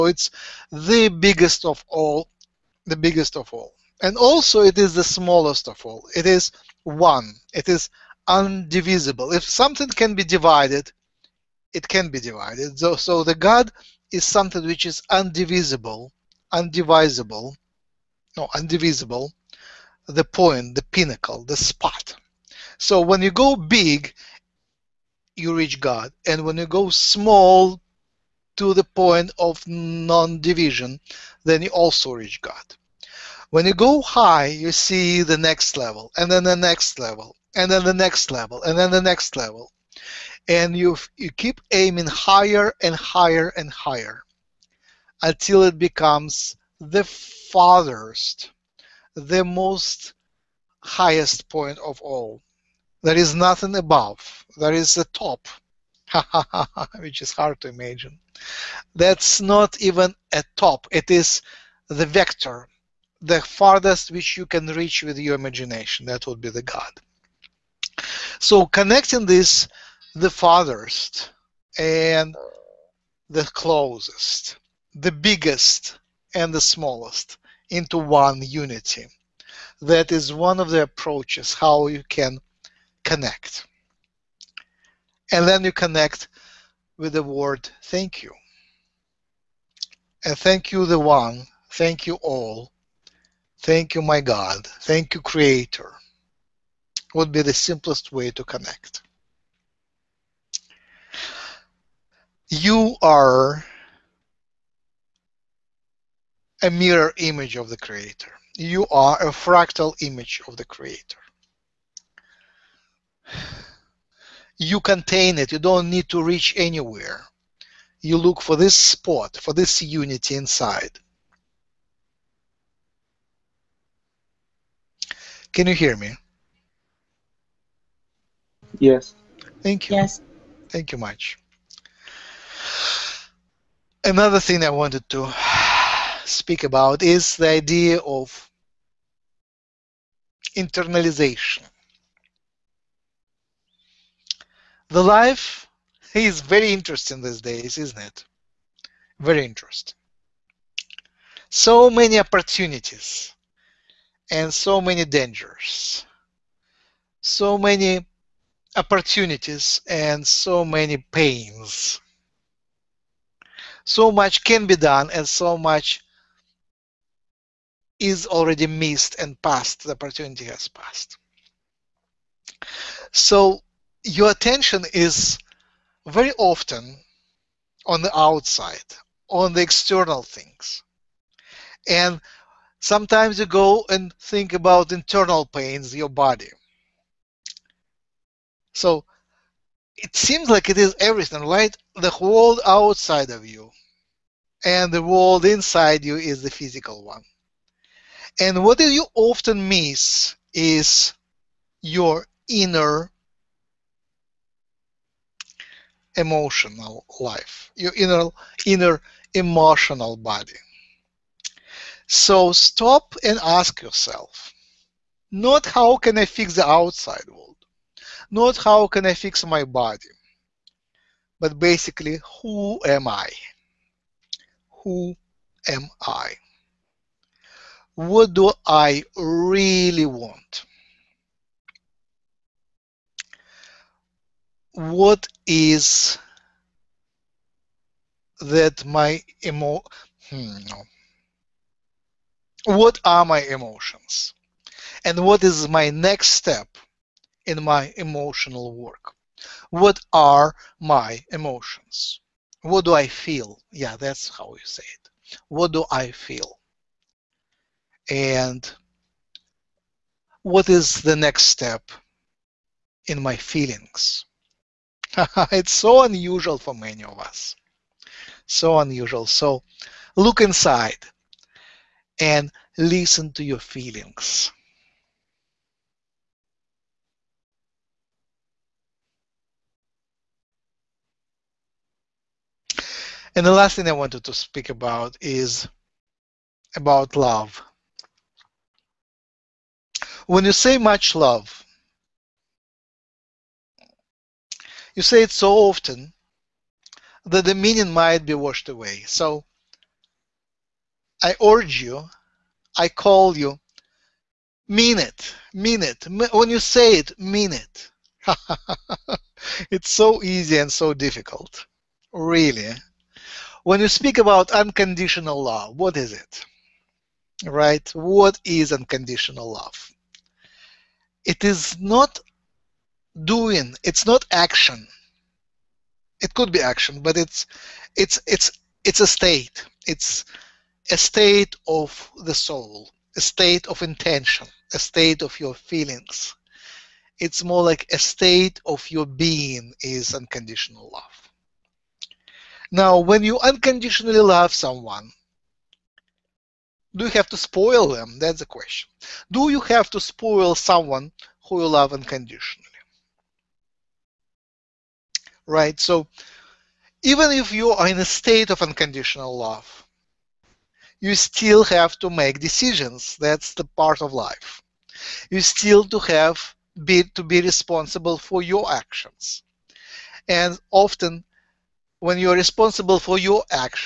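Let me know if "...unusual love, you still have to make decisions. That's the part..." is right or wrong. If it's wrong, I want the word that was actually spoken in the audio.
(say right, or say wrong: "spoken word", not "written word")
wrong: "unconditional", not "unusual".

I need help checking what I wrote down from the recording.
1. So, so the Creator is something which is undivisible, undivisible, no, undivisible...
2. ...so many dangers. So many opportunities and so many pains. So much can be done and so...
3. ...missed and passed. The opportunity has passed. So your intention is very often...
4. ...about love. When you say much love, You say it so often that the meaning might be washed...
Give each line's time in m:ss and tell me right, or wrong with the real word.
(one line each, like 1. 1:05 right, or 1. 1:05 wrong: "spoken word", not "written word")
1. 0:12 wrong: "God", not "Creator"
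2. 2:34 right
3. 2:48 wrong: "attention", not "intention"
4. 4:46 right.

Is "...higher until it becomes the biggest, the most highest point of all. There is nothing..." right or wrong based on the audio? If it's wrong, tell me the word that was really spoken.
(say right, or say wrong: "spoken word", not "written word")
wrong: "farthest", not "biggest".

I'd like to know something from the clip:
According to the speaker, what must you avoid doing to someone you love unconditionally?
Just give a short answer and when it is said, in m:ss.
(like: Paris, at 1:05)
spoil them, at 5:47.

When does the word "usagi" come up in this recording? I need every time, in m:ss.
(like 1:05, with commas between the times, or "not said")
not said.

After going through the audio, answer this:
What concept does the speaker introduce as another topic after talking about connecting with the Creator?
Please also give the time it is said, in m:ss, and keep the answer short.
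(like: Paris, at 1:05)
internalization, at 2:20.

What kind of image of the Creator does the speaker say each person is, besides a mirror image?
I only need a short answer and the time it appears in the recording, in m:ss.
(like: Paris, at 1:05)
fractal image, at 1:49.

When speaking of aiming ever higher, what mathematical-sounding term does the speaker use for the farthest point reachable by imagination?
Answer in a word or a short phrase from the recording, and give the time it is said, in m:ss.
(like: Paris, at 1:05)
the vector, at 1:01.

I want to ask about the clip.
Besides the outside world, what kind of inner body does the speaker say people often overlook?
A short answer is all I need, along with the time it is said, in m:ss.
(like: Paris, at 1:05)
emotional body, at 3:28.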